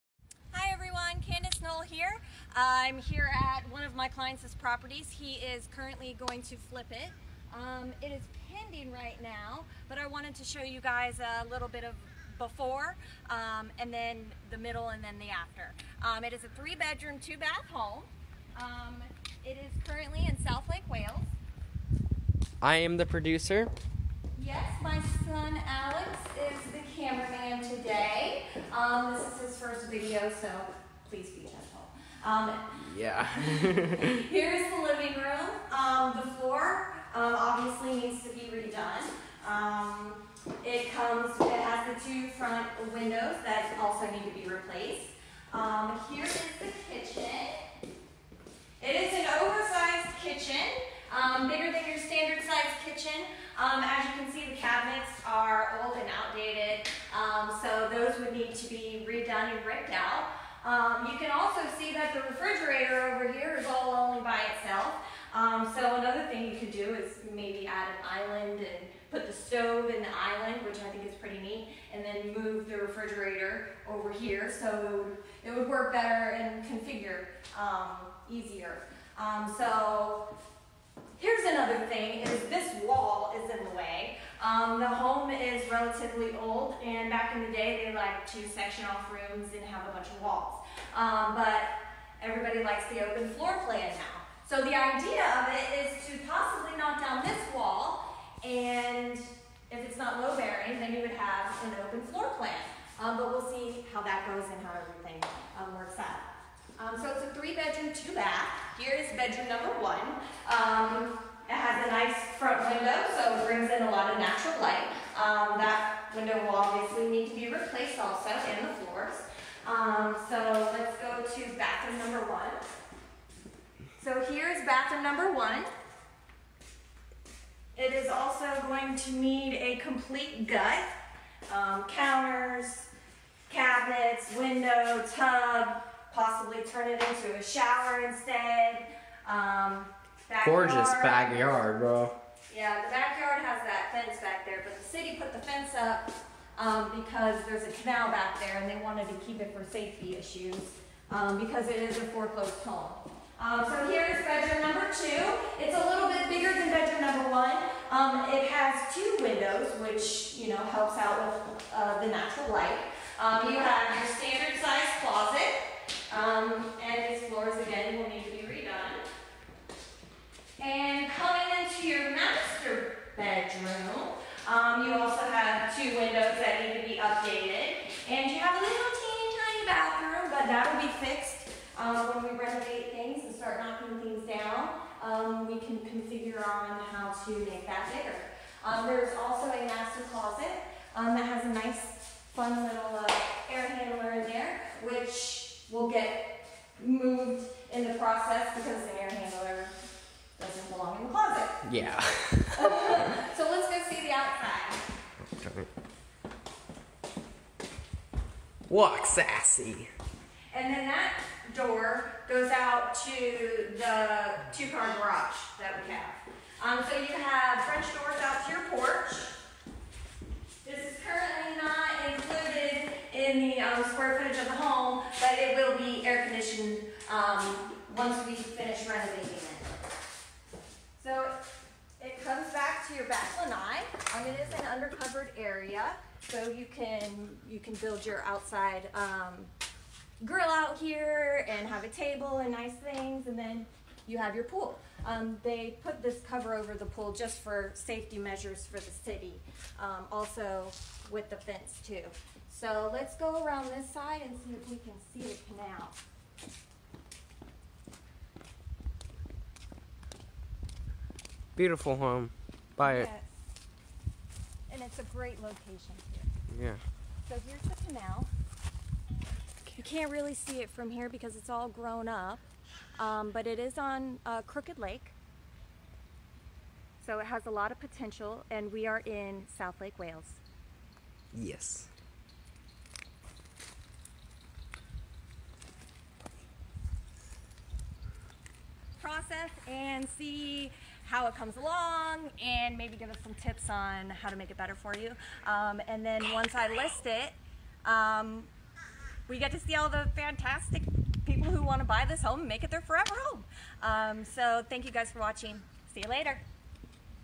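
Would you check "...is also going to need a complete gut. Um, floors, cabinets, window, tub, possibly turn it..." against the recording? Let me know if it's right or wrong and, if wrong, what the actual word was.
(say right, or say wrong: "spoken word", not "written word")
wrong: "counters", not "floors".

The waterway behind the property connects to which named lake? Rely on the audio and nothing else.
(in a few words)
Crooked Lake.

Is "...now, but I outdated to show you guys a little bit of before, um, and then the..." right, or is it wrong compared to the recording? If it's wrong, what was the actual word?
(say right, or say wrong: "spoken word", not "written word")
wrong: "wanted", not "outdated".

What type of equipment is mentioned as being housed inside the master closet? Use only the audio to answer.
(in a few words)
air handler.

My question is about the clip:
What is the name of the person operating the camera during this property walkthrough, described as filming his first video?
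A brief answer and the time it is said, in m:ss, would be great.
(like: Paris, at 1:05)
Alex, at 0:25.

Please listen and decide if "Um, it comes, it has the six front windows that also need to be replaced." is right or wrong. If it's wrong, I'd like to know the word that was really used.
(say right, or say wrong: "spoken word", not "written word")
wrong: "two", not "six".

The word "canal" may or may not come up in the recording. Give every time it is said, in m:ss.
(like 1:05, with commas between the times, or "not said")
2:27, 4:15, 4:27.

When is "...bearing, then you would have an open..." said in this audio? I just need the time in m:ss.
1:40.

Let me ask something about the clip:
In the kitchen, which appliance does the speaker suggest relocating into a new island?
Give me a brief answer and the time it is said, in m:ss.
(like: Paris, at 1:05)
stove, at 1:09.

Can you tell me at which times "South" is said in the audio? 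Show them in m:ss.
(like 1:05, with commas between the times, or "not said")
0:20, 4:39.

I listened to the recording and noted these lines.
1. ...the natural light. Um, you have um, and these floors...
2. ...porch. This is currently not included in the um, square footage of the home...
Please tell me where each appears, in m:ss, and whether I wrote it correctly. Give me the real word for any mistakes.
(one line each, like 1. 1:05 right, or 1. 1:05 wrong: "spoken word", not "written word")
1. 2:42 right
2. 3:38 right.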